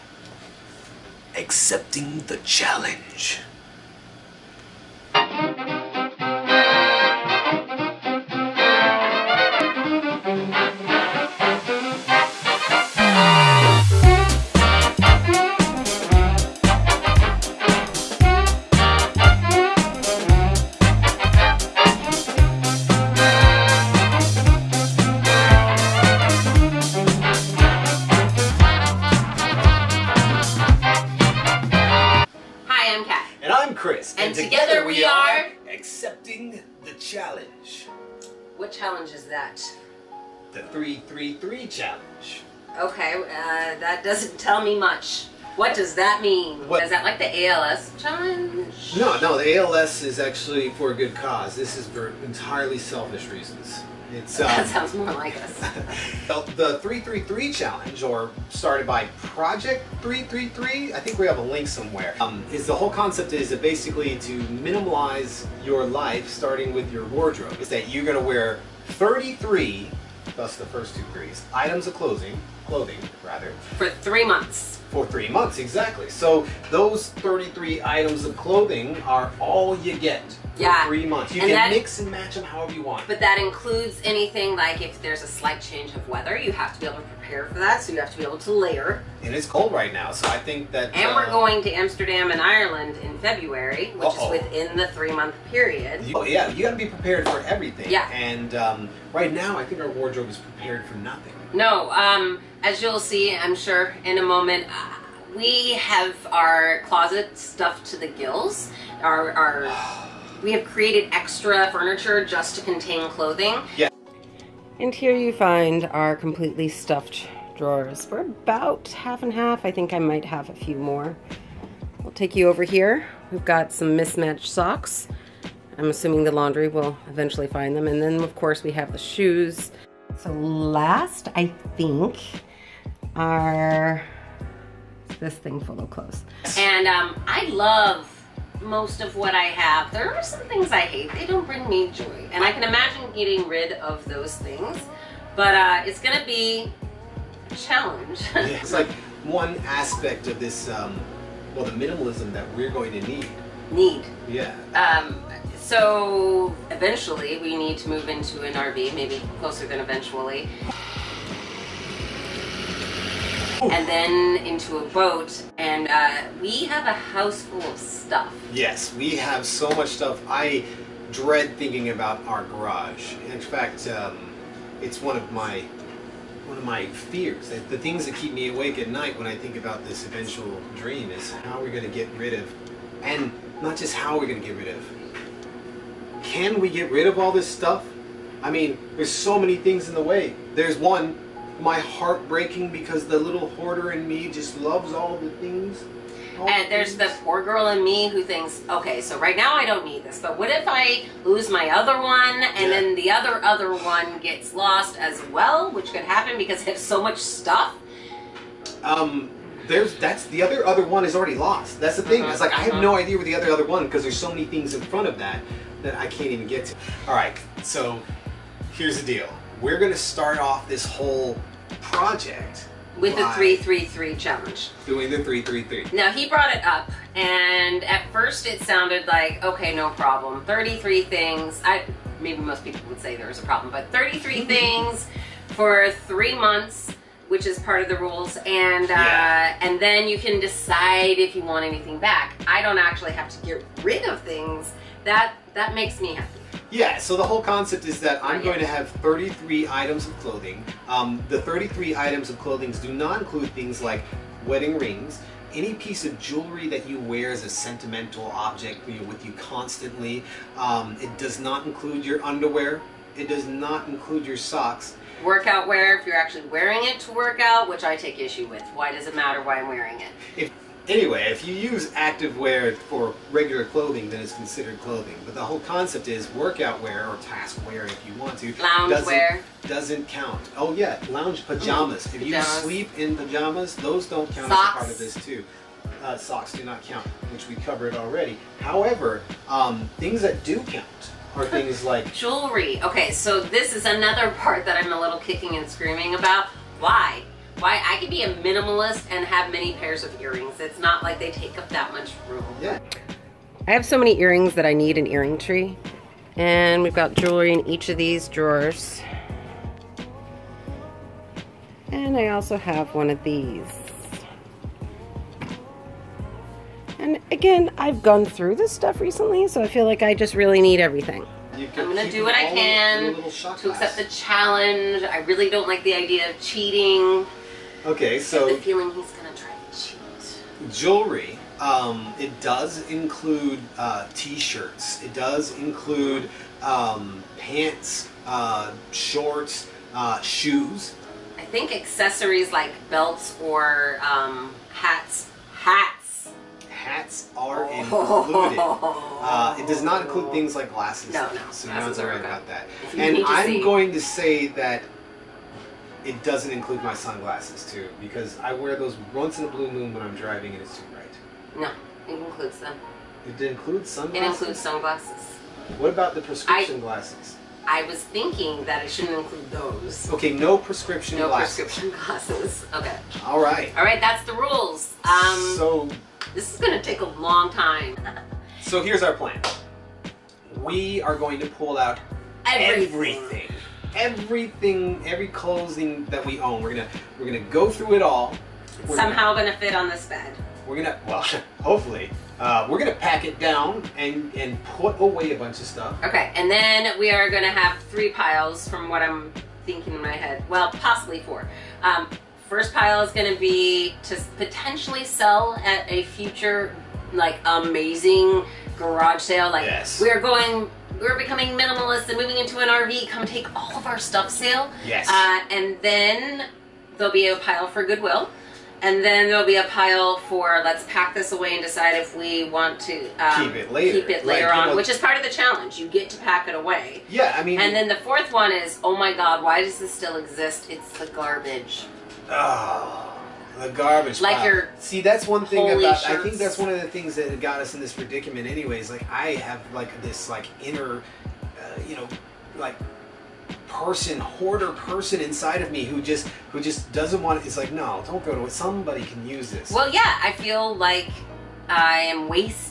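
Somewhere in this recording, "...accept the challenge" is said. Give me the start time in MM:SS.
05:23.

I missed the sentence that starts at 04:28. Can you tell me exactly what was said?
Why does it matter why I'm wearing it?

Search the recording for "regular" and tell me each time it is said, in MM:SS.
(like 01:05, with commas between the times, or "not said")
04:33.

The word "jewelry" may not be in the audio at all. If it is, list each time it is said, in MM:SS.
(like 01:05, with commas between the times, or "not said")
04:16, 04:52, 05:07, 05:30.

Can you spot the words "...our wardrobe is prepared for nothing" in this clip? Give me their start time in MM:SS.
01:39.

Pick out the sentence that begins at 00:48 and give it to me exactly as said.
No, no, the ALS is actually for a good cause.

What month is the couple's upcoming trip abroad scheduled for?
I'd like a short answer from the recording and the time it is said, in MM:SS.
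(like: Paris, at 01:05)
February, at 01:33.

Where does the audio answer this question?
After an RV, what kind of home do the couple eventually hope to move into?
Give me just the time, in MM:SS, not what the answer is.
02:44.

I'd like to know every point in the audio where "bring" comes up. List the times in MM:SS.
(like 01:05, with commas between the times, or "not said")
02:21.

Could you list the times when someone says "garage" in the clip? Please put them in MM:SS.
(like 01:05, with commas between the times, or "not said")
02:52, 06:48.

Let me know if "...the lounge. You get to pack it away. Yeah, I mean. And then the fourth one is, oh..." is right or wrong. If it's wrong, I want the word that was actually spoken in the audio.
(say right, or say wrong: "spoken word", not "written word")
wrong: "challenge", not "lounge".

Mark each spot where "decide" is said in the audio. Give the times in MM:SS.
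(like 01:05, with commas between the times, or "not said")
04:00, 07:01.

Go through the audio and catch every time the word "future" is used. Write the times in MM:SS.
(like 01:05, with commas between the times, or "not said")
06:46.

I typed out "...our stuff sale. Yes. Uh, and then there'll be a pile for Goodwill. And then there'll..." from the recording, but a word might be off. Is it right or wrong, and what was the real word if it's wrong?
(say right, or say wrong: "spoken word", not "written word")
right.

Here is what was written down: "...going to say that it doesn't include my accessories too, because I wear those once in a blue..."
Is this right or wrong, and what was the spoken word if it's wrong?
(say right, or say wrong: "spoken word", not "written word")
wrong: "sunglasses", not "accessories".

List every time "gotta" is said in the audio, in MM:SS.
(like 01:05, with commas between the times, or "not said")
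01:36.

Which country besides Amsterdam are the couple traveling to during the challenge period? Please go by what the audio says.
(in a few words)
Ireland.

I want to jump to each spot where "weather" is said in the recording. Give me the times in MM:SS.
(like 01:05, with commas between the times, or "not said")
01:26.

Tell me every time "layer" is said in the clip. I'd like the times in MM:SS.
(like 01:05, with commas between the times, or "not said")
01:28.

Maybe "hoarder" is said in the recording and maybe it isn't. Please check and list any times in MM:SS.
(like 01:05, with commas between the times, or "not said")
03:13, 07:24.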